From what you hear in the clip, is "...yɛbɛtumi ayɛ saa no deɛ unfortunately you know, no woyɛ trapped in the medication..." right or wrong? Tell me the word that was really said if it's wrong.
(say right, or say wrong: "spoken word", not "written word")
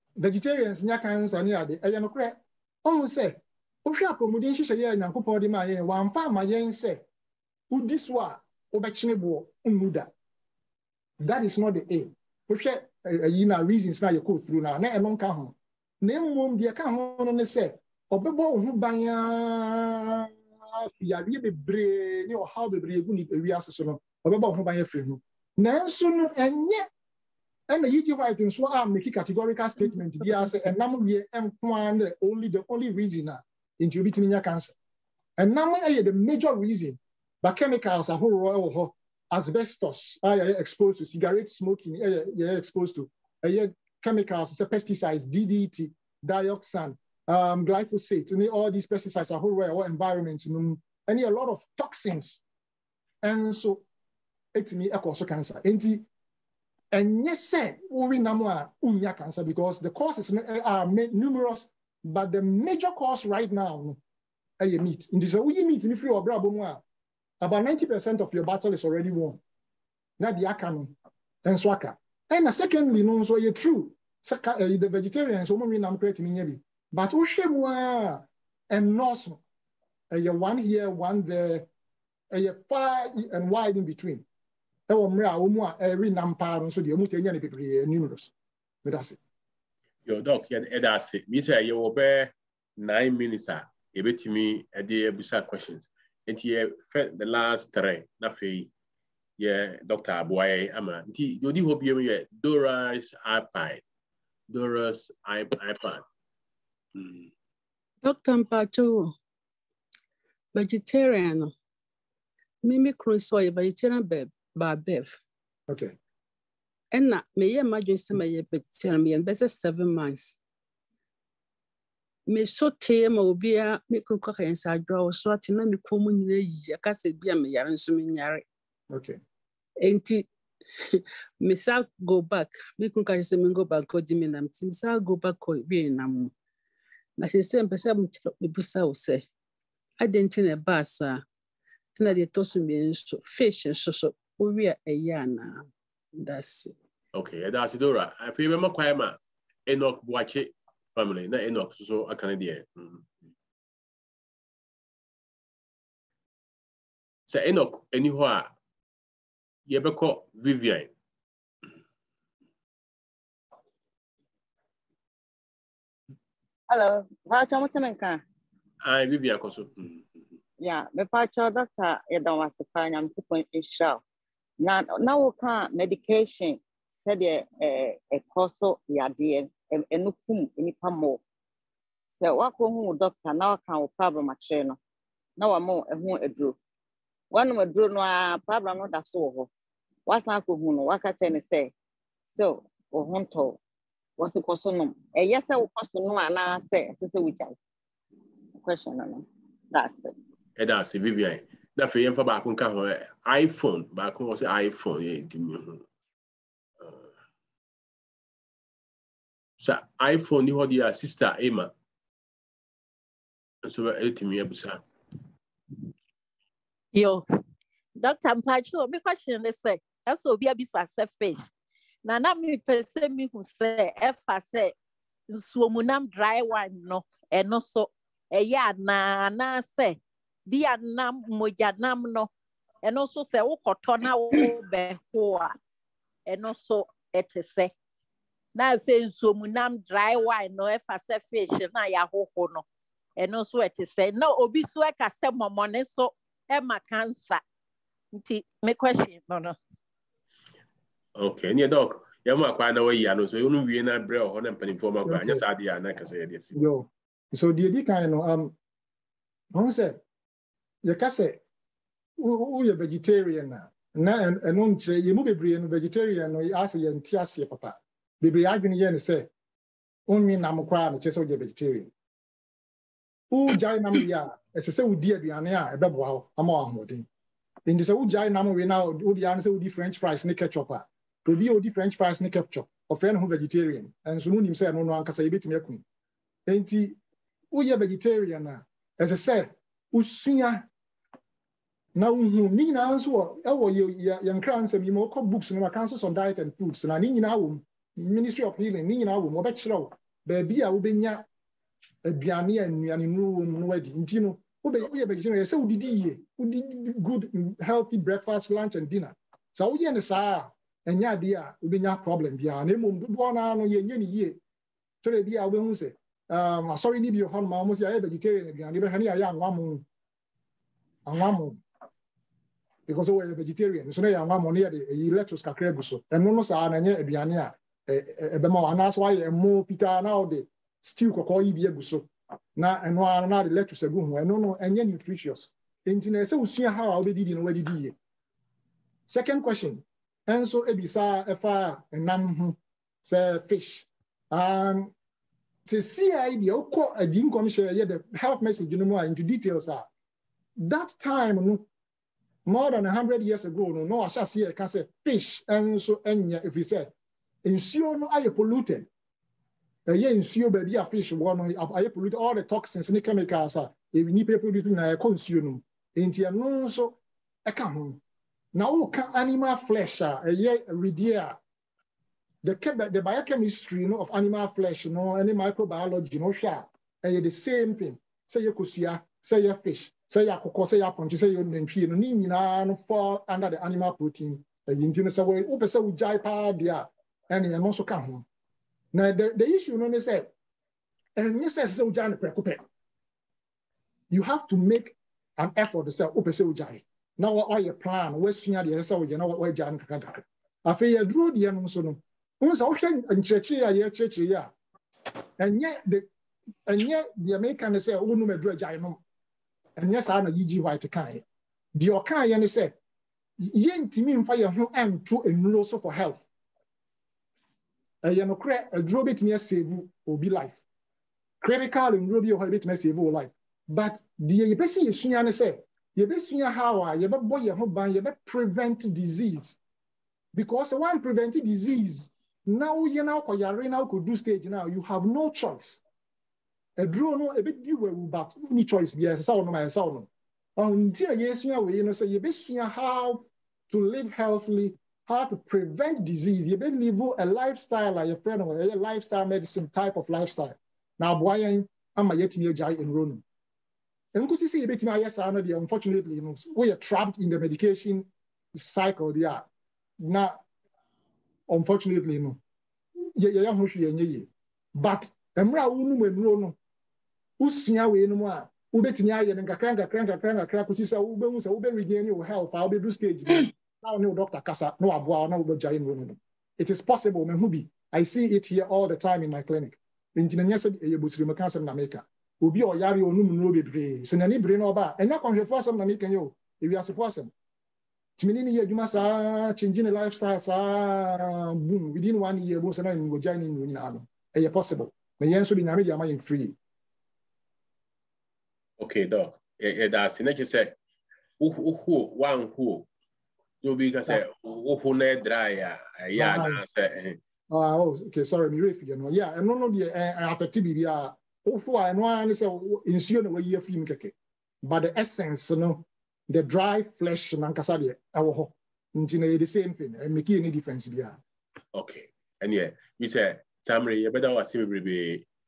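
right.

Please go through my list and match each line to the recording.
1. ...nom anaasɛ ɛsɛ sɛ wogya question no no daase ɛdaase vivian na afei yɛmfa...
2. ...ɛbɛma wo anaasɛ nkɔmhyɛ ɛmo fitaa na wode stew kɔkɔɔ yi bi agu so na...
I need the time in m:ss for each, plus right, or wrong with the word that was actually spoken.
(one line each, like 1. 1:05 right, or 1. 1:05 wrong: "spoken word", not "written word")
1. 3:15 right
2. 5:28 wrong: "woayɛ", not "nkɔmhyɛ".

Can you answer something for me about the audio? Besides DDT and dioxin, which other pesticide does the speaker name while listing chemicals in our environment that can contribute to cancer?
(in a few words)
Glyphosate.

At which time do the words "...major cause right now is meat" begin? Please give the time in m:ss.
1:02.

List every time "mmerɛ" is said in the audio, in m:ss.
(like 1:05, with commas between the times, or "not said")
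1:25, 7:45.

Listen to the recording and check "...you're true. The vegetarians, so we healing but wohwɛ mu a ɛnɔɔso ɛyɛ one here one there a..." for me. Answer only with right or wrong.
wrong.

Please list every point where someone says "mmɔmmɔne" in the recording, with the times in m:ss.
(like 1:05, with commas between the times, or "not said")
4:05.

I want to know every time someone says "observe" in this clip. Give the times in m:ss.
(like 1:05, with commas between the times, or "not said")
not said.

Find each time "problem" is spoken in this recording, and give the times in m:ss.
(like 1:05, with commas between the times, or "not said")
3:03, 3:08, 5:12.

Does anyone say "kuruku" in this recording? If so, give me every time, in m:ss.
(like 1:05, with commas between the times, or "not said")
2:04, 2:12.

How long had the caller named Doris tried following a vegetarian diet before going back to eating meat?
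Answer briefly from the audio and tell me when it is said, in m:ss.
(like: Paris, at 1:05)
7 months, at 1:59.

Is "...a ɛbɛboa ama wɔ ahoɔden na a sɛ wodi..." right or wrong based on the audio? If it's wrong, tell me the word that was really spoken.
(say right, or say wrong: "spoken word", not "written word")
right.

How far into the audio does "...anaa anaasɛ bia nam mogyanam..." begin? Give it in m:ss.
3:48.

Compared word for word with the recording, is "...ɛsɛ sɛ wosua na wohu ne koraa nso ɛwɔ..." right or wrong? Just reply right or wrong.
wrong.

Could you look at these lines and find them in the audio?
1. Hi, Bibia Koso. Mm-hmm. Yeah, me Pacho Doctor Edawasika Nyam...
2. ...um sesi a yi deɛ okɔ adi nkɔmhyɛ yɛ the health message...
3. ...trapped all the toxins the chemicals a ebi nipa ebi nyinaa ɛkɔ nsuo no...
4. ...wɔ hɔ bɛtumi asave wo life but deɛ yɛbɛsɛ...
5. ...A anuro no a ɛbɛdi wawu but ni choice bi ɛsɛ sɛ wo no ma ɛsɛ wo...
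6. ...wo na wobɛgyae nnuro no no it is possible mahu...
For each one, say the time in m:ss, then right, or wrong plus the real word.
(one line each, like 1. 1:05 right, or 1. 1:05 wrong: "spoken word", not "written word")
1. 2:48 right
2. 5:44 right
3. 6:01 wrong: "polluted", not "trapped"
4. 7:02 right
5. 7:16 wrong: "aduro", not "anuro"
6. 7:55 right.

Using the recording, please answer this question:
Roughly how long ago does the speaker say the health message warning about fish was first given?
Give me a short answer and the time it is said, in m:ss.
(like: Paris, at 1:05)
More than 100 years ago, at 5:52.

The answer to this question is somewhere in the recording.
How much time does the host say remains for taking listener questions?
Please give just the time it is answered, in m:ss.
1:32.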